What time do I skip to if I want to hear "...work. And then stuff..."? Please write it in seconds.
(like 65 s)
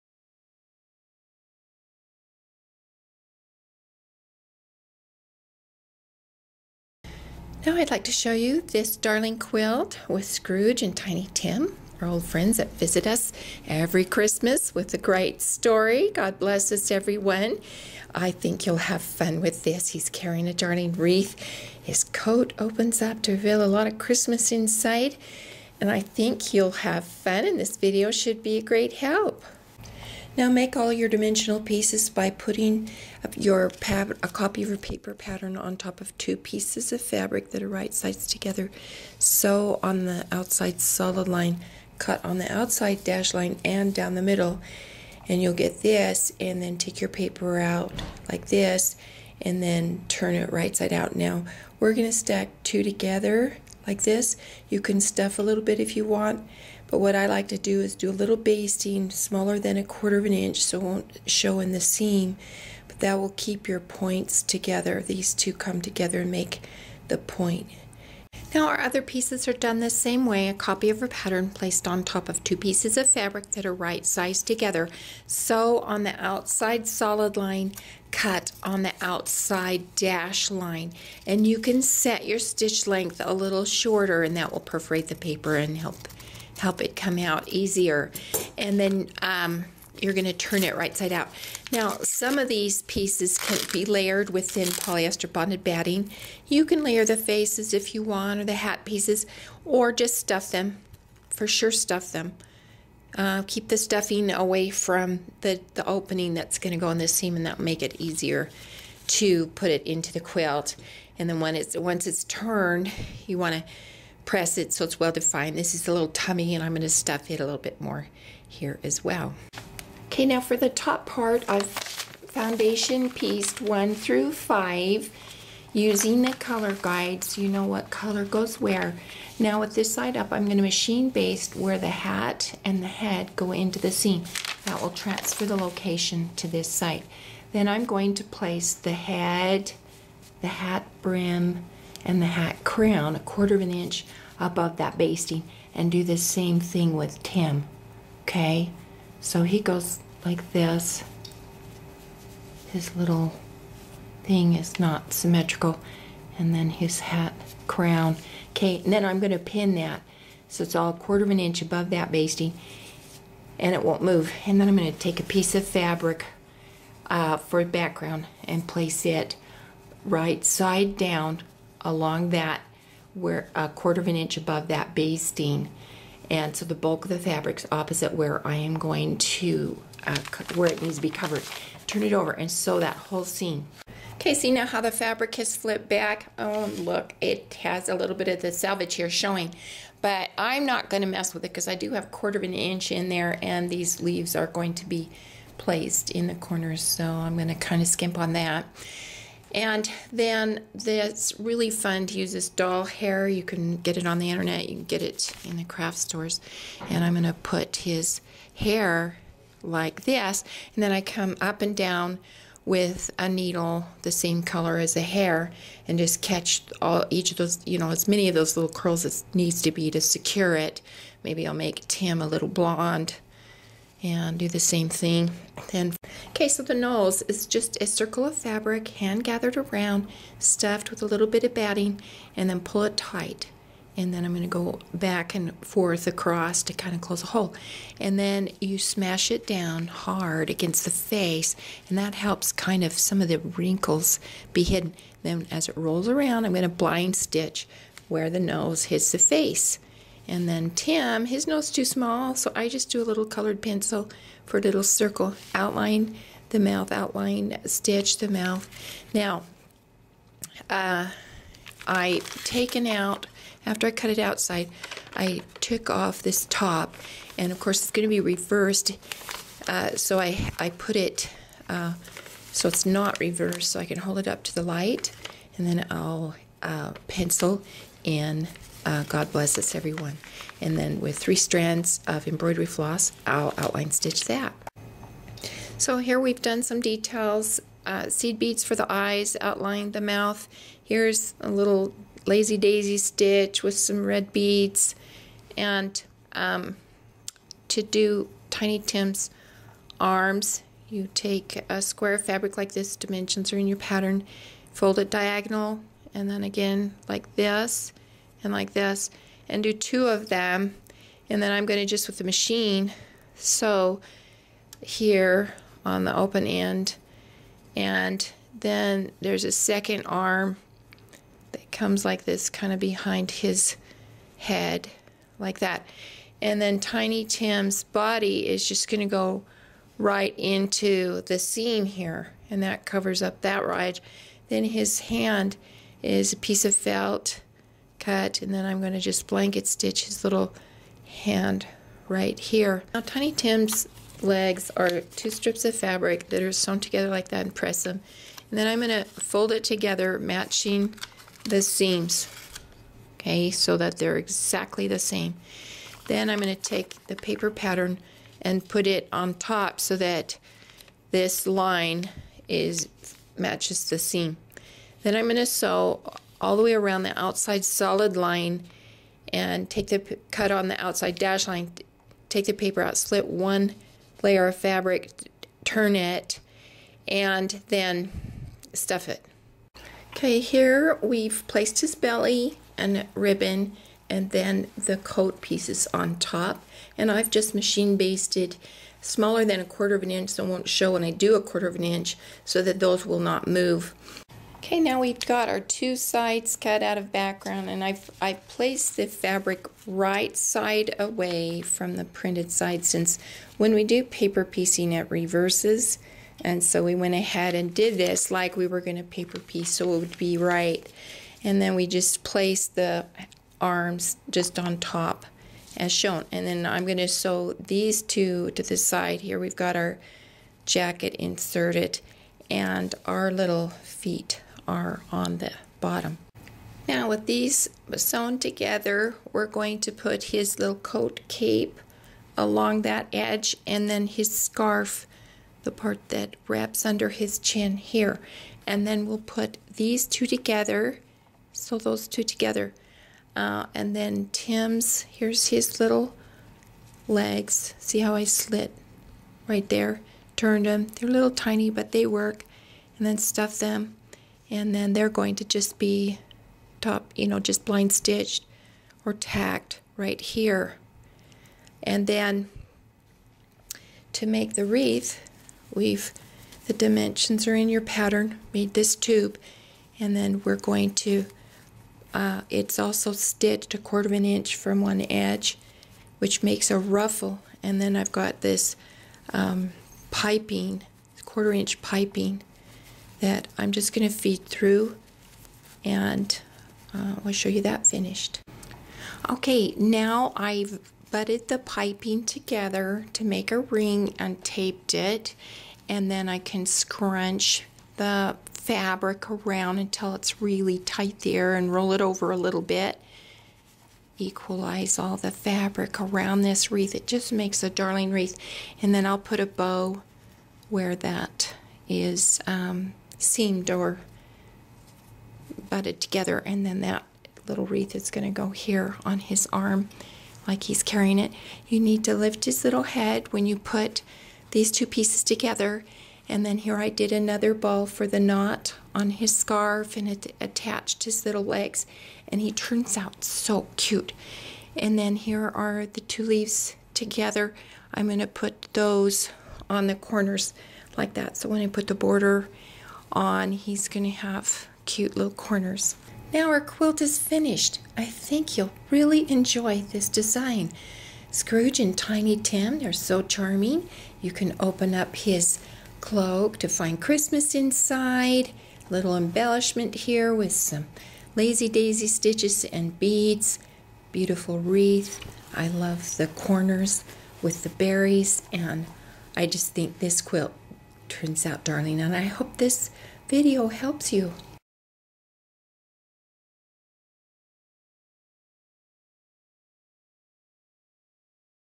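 452 s.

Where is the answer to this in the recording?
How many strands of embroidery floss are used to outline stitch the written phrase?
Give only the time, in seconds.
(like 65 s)
281 s.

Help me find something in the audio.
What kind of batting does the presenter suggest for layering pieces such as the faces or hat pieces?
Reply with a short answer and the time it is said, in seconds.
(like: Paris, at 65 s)
thin polyester bonded batting, at 94 s.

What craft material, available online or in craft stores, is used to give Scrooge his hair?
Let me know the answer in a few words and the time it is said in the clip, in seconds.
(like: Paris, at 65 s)
doll hair, at 202 s.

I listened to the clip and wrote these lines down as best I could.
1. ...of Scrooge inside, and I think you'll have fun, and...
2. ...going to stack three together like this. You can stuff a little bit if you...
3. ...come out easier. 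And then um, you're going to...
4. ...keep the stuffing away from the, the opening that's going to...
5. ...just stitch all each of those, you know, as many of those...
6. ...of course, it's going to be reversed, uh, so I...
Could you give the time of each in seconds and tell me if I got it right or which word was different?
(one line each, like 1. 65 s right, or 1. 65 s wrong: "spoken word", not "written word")
1. 23 s wrong: "Christmas", not "Scrooge"
2. 51 s wrong: "two", not "three"
3. 86 s right
4. 103 s right
5. 215 s wrong: "catch", not "stitch"
6. 267 s right.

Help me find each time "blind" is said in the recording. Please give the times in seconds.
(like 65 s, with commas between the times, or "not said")
246 s, 457 s.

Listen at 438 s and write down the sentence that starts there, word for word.
And then we'll put these two together, so those two together.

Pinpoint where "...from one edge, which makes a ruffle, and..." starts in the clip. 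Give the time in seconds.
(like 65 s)
474 s.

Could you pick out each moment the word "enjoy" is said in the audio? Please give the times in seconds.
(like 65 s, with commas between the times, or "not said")
549 s.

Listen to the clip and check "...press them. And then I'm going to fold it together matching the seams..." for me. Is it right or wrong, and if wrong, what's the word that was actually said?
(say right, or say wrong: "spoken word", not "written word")
right.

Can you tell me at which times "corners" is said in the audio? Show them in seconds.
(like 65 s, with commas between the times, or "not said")
196 s, 539 s, 545 s, 566 s.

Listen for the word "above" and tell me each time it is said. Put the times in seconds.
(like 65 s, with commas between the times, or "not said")
144 s, 161 s, 174 s.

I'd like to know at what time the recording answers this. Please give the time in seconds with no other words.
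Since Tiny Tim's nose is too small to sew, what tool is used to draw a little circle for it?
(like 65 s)
253 s.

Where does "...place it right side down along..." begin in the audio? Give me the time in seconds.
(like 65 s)
168 s.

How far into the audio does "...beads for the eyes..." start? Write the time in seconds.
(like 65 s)
288 s.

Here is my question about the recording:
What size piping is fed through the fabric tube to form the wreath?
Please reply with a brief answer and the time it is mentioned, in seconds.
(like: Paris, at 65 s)
quarter inch, at 481 s.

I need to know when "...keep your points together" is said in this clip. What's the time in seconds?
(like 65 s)
63 s.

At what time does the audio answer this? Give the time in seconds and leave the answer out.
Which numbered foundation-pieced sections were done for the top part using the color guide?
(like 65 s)
123 s.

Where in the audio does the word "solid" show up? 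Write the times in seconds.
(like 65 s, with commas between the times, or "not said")
40 s, 76 s, 367 s.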